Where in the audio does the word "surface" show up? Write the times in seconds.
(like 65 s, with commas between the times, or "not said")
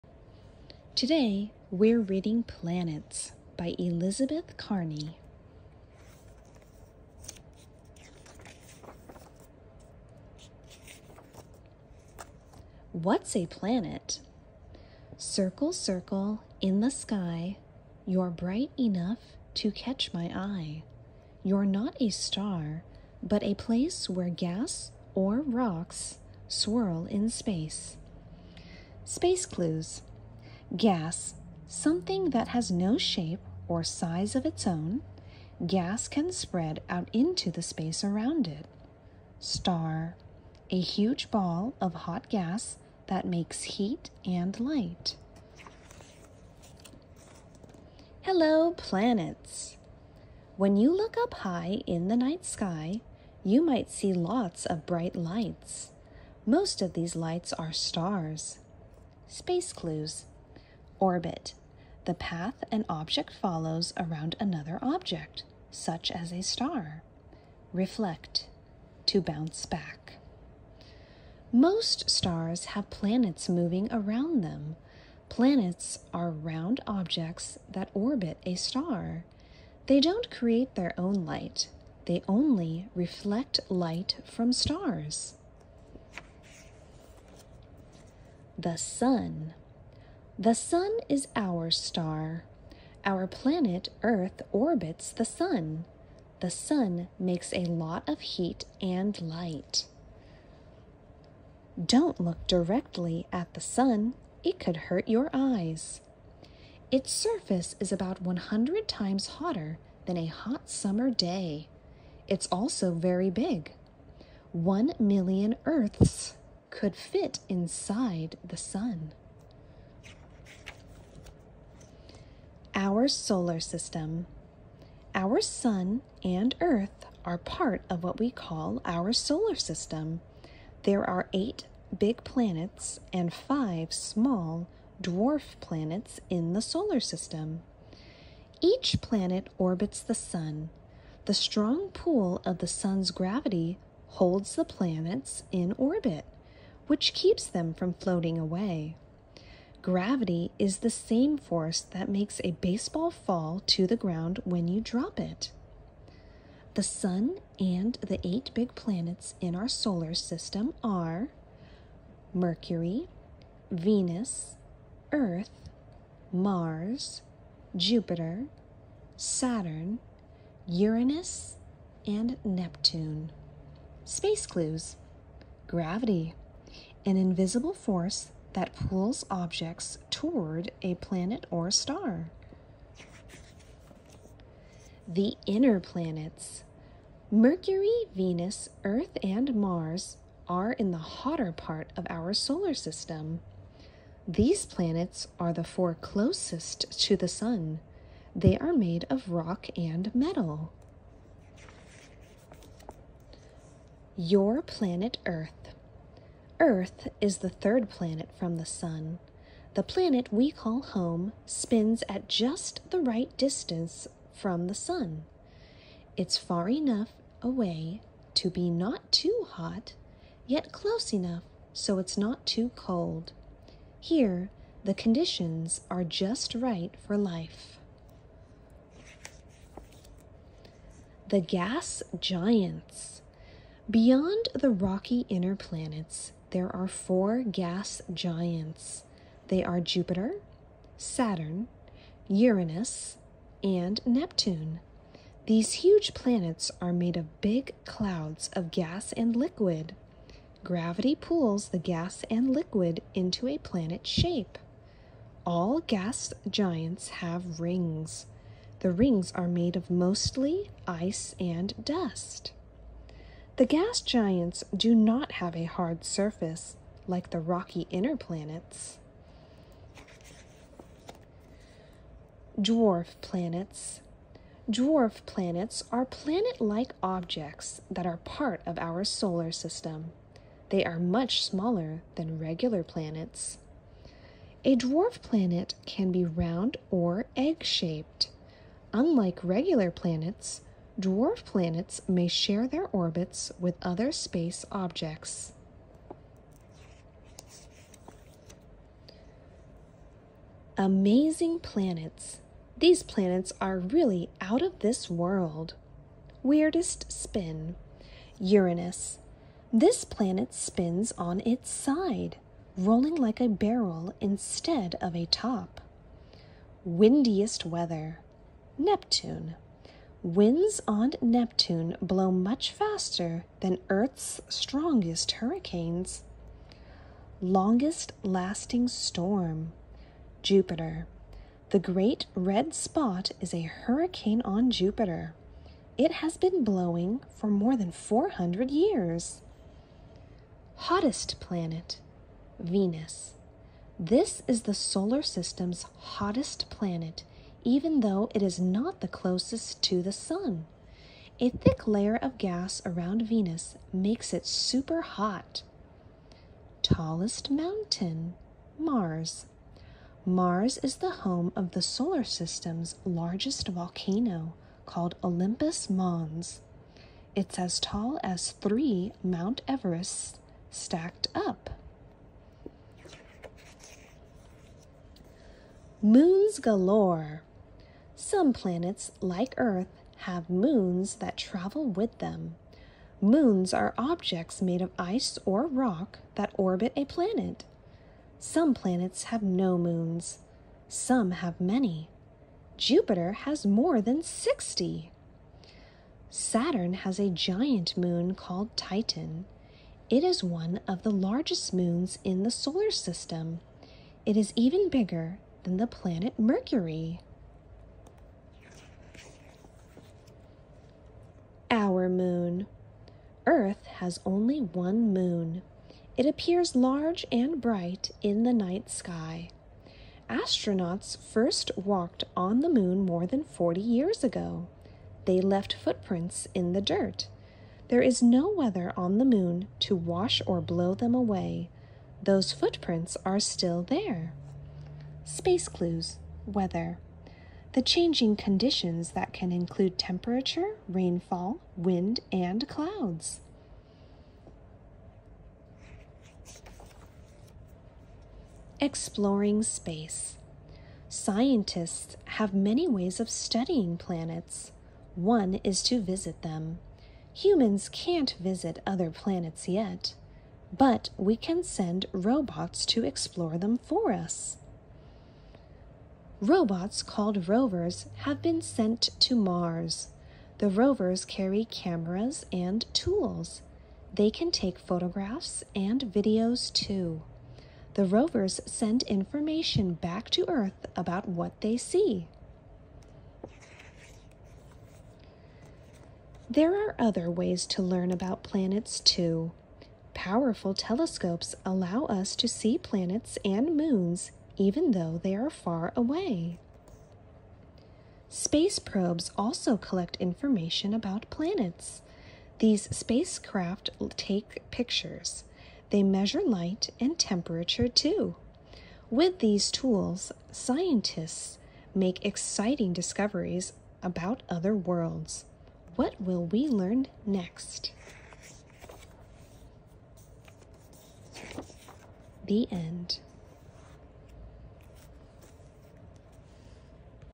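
107 s, 266 s.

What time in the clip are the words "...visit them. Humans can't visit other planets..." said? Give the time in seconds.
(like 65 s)
456 s.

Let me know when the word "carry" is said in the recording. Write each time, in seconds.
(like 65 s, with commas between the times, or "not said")
471 s.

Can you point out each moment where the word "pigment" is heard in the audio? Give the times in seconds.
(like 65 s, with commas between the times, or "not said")
not said.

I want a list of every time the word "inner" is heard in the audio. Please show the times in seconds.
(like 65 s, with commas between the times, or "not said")
185 s, 235 s, 267 s.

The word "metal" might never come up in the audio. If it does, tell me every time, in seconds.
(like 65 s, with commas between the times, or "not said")
200 s.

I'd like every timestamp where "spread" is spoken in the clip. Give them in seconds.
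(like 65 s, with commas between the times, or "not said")
36 s.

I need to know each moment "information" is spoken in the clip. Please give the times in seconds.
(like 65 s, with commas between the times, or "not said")
479 s, 500 s.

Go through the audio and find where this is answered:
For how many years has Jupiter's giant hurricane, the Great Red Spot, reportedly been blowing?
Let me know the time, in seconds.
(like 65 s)
337 s.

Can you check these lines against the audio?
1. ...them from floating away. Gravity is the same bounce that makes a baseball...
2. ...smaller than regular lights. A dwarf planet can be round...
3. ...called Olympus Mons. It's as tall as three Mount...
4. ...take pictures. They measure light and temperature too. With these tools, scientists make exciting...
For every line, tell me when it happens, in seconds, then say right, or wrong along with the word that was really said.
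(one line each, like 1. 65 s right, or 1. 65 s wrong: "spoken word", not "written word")
1. 147 s wrong: "force", not "bounce"
2. 281 s wrong: "planets", not "lights"
3. 364 s right
4. 504 s right.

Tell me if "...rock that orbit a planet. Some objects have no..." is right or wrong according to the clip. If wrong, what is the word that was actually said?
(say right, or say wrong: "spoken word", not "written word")
wrong: "planets", not "objects".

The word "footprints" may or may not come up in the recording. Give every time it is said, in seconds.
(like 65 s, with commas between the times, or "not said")
425 s, 432 s.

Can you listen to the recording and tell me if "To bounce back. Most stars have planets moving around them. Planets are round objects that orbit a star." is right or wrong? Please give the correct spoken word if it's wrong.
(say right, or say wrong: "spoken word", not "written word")
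right.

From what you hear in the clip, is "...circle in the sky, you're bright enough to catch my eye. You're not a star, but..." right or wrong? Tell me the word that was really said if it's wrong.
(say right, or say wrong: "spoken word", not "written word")
right.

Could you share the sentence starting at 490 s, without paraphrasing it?
Powerful telescopes allow us to see planets and moons even though they are far away.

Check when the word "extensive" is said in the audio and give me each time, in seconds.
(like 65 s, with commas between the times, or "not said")
not said.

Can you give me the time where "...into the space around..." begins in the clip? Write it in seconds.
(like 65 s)
37 s.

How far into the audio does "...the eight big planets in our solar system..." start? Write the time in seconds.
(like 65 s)
158 s.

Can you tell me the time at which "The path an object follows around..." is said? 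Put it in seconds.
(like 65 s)
62 s.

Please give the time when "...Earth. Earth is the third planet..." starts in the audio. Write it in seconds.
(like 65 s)
205 s.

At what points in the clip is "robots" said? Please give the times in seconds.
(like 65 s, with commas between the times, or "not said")
462 s, 466 s.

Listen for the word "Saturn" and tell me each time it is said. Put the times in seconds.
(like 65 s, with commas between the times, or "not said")
169 s, 240 s, 396 s.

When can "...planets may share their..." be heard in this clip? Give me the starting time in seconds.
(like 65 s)
291 s.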